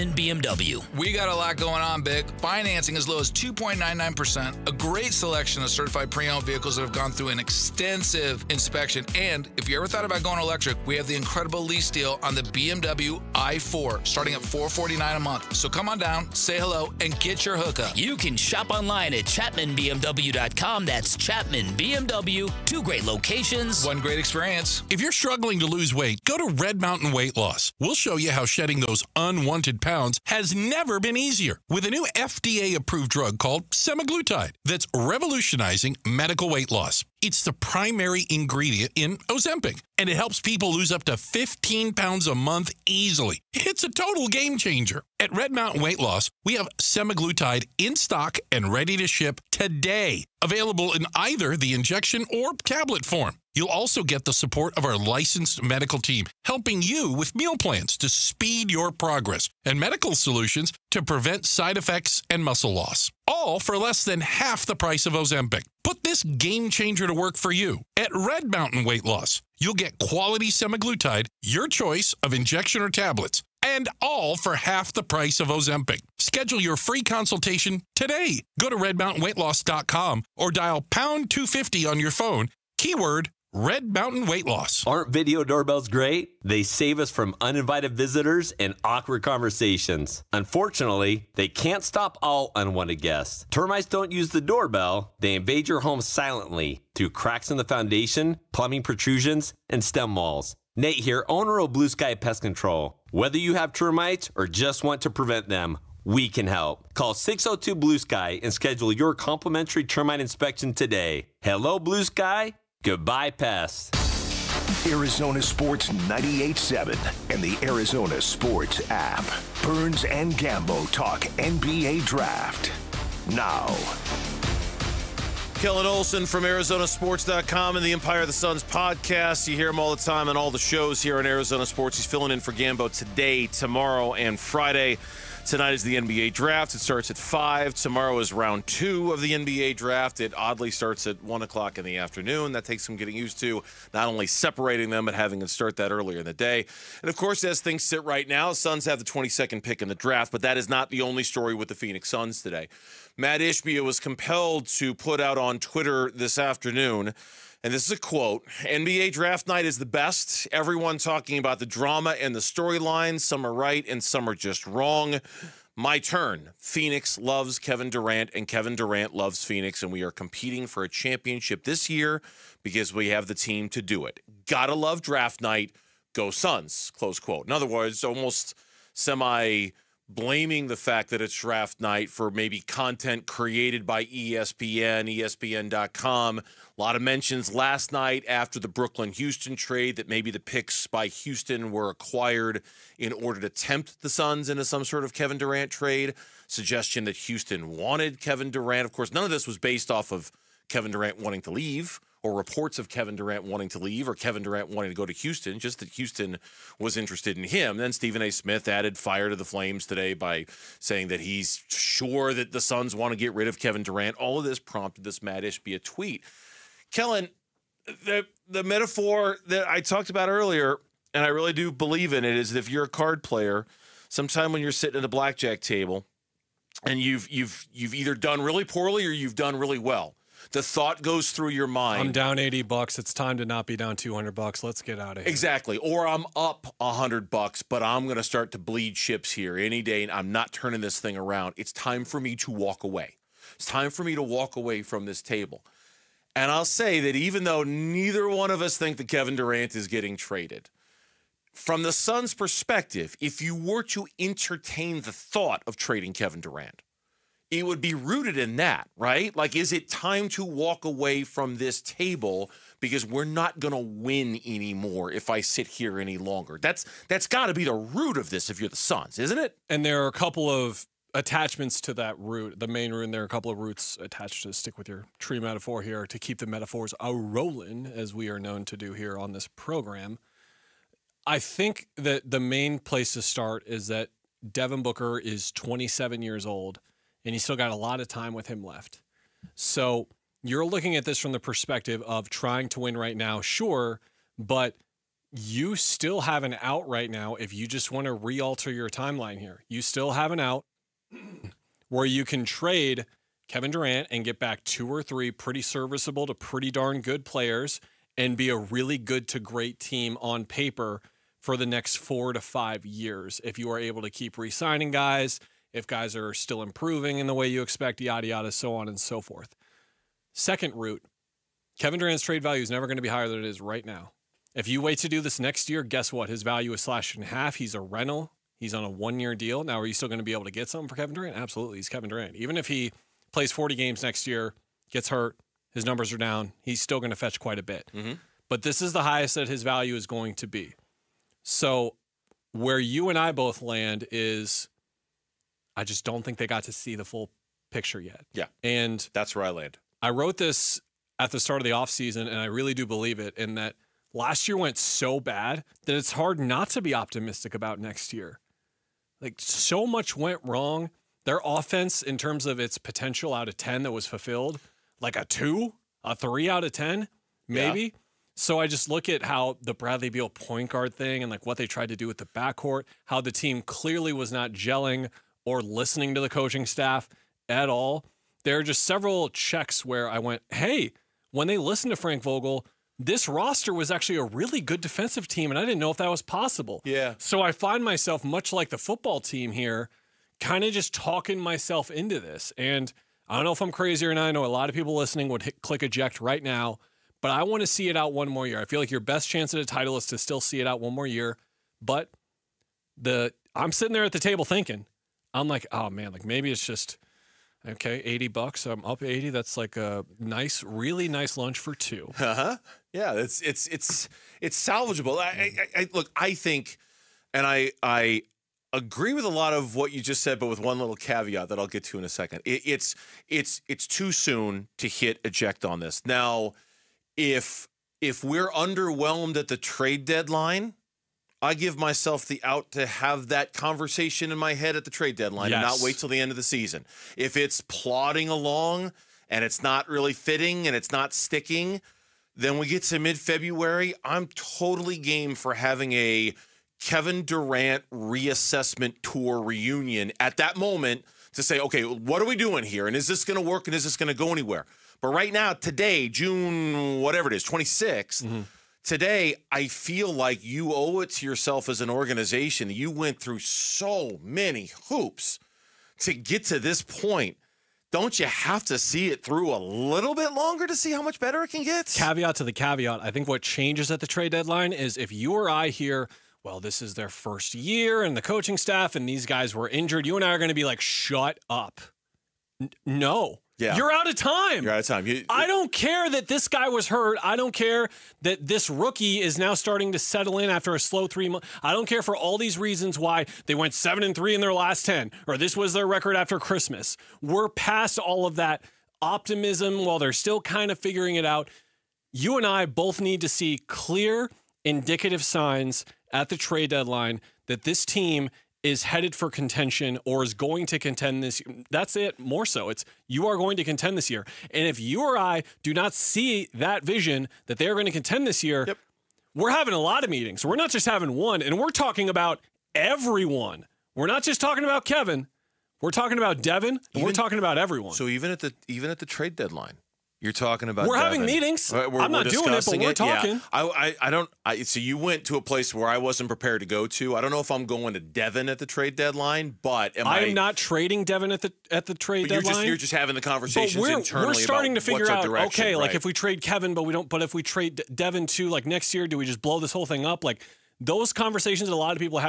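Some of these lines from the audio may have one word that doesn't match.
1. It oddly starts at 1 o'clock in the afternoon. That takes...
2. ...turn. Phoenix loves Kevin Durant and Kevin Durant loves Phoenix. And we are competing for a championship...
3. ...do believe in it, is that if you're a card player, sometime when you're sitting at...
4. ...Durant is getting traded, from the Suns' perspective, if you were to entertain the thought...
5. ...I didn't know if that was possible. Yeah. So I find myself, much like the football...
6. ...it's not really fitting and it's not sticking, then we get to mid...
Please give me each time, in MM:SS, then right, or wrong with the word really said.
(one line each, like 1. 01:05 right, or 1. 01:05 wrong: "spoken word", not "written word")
1. 02:20 right
2. 02:45 right
3. 03:41 right
4. 04:09 right
5. 06:25 right
6. 07:19 right.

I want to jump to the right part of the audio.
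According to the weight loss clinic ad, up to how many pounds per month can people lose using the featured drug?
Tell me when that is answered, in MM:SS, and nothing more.
00:41.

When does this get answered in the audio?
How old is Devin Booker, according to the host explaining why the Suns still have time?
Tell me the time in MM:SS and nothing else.
04:45.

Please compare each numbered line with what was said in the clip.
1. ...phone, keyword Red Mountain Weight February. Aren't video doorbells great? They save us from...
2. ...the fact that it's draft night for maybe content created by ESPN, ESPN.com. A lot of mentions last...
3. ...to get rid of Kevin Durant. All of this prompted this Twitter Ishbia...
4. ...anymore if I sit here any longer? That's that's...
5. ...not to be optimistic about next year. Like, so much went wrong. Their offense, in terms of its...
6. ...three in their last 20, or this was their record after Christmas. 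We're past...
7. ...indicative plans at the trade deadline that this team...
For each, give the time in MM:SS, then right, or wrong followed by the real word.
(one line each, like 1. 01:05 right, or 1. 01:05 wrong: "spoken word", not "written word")
1. 01:22 wrong: "Loss", not "February"
2. 03:00 right
3. 03:33 wrong: "Mat", not "Twitter"
4. 04:24 right
5. 05:56 right
6. 08:14 wrong: "10", not "20"
7. 08:24 wrong: "signs", not "plans".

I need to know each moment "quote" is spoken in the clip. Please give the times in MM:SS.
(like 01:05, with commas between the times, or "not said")
02:37, 02:57.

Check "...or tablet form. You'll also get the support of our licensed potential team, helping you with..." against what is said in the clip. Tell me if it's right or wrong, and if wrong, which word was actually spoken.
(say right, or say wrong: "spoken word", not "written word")
wrong: "medical", not "potential".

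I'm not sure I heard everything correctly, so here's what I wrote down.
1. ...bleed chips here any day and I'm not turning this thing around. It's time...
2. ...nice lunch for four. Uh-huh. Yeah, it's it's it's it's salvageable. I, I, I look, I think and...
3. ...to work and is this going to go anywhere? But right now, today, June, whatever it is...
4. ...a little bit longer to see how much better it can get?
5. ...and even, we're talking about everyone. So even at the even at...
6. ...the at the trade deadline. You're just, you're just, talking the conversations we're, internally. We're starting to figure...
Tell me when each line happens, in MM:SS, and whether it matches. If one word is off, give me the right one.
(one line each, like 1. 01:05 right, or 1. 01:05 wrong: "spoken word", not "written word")
1. 03:58 right
2. 06:51 wrong: "two", not "four"
3. 07:33 right
4. 07:49 right
5. 08:46 right
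6. 09:01 wrong: "having", not "talking".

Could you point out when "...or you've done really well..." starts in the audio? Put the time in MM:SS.
03:49.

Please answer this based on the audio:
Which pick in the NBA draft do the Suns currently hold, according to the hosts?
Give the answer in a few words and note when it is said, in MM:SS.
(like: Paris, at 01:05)
22nd, at 02:29.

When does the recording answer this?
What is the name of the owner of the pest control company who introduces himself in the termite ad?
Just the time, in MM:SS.
01:40.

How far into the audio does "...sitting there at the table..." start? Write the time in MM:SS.
06:43.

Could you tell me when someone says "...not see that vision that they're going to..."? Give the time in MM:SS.
08:35.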